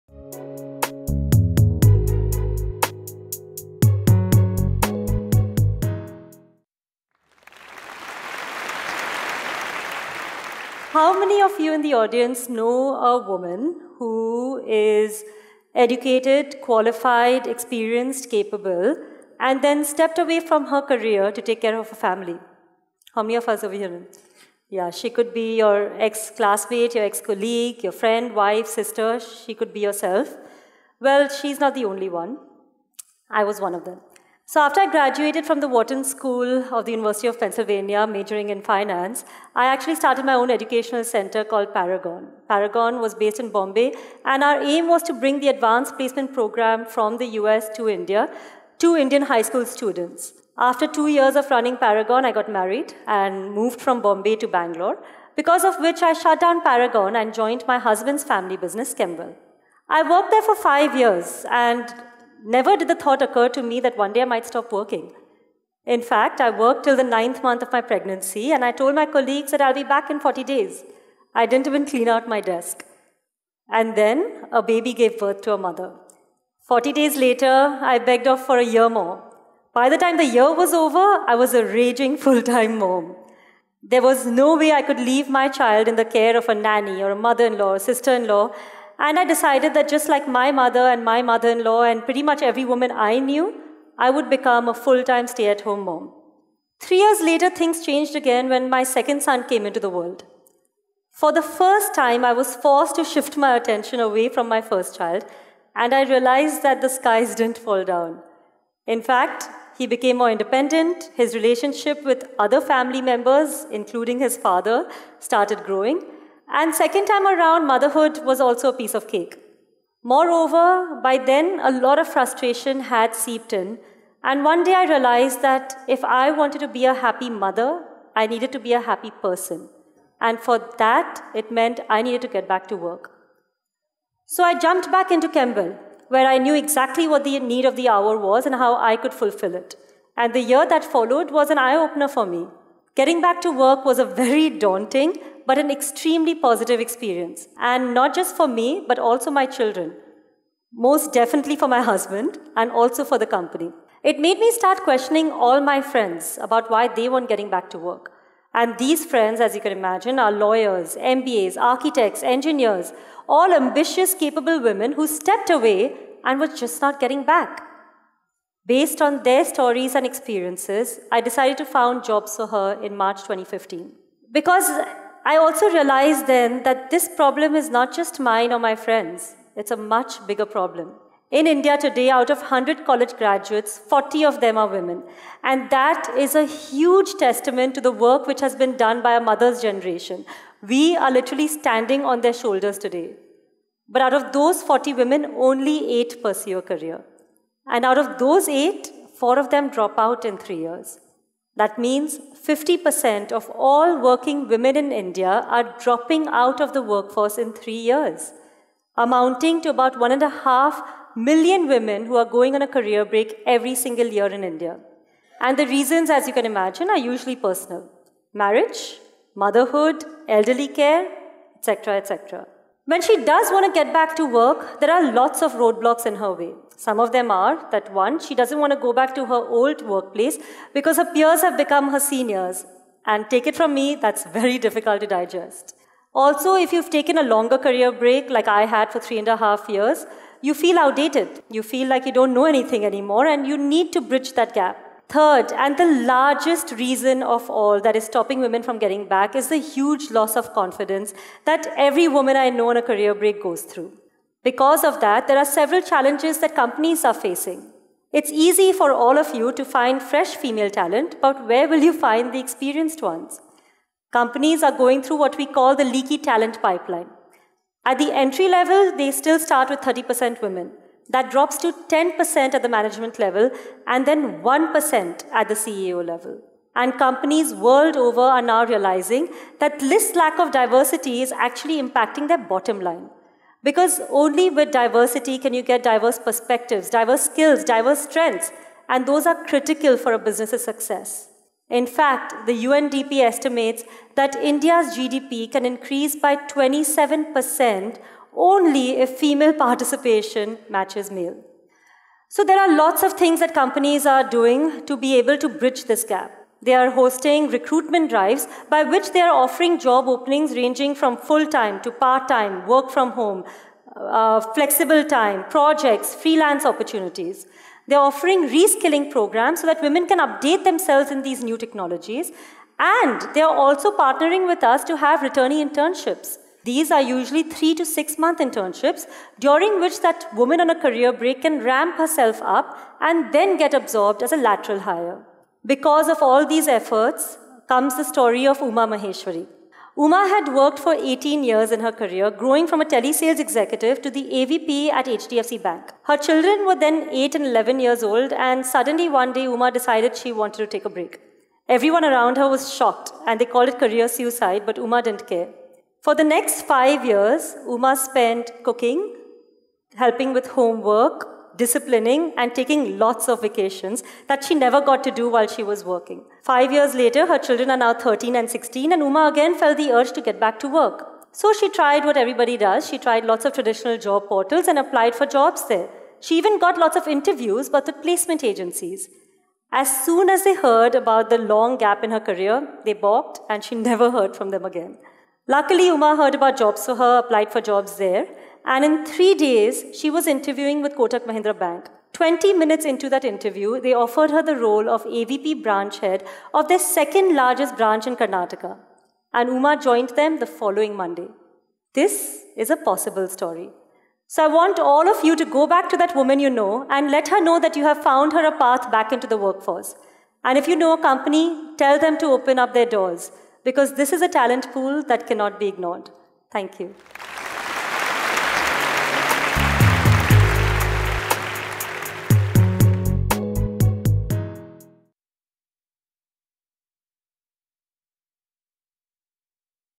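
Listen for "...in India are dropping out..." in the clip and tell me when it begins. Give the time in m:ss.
3:24.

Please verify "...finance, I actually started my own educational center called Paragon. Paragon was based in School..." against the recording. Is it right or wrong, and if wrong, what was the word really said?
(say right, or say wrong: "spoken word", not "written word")
wrong: "Bombay", not "School".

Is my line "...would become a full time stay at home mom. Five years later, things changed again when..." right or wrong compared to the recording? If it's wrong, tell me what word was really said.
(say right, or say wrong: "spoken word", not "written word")
wrong: "Three", not "Five".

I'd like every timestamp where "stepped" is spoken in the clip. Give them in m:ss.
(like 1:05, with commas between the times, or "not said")
0:19, 2:45.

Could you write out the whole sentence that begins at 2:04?
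And one day I realized that if I wanted to be a happy mother, I needed to be a happy person.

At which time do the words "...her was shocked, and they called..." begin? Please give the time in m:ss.
5:52.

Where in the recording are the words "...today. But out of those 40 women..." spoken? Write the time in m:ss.
3:12.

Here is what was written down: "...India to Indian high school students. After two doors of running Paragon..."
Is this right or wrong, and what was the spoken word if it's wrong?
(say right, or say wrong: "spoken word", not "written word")
wrong: "years", not "doors".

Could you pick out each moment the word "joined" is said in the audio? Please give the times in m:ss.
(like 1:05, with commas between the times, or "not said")
0:57, 6:39.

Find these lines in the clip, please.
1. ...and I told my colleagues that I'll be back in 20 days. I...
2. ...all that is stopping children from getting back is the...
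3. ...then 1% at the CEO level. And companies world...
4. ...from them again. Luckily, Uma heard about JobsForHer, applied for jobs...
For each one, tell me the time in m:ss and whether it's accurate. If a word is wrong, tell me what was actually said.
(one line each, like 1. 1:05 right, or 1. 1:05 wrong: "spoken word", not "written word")
1. 1:08 wrong: "40", not "20"
2. 4:07 wrong: "women", not "children"
3. 4:34 right
4. 6:24 right.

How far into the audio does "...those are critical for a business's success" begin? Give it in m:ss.
4:49.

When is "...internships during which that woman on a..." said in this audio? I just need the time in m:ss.
5:28.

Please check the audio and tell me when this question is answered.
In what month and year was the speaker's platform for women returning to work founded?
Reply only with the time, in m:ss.
2:52.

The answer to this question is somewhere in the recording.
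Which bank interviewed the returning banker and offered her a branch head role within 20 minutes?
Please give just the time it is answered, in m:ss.
6:30.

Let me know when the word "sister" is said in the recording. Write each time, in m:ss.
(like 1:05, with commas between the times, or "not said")
0:28, 1:27.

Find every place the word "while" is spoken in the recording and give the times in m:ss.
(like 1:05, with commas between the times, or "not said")
6:05.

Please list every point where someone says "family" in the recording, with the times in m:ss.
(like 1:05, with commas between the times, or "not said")
0:22, 0:58, 1:52.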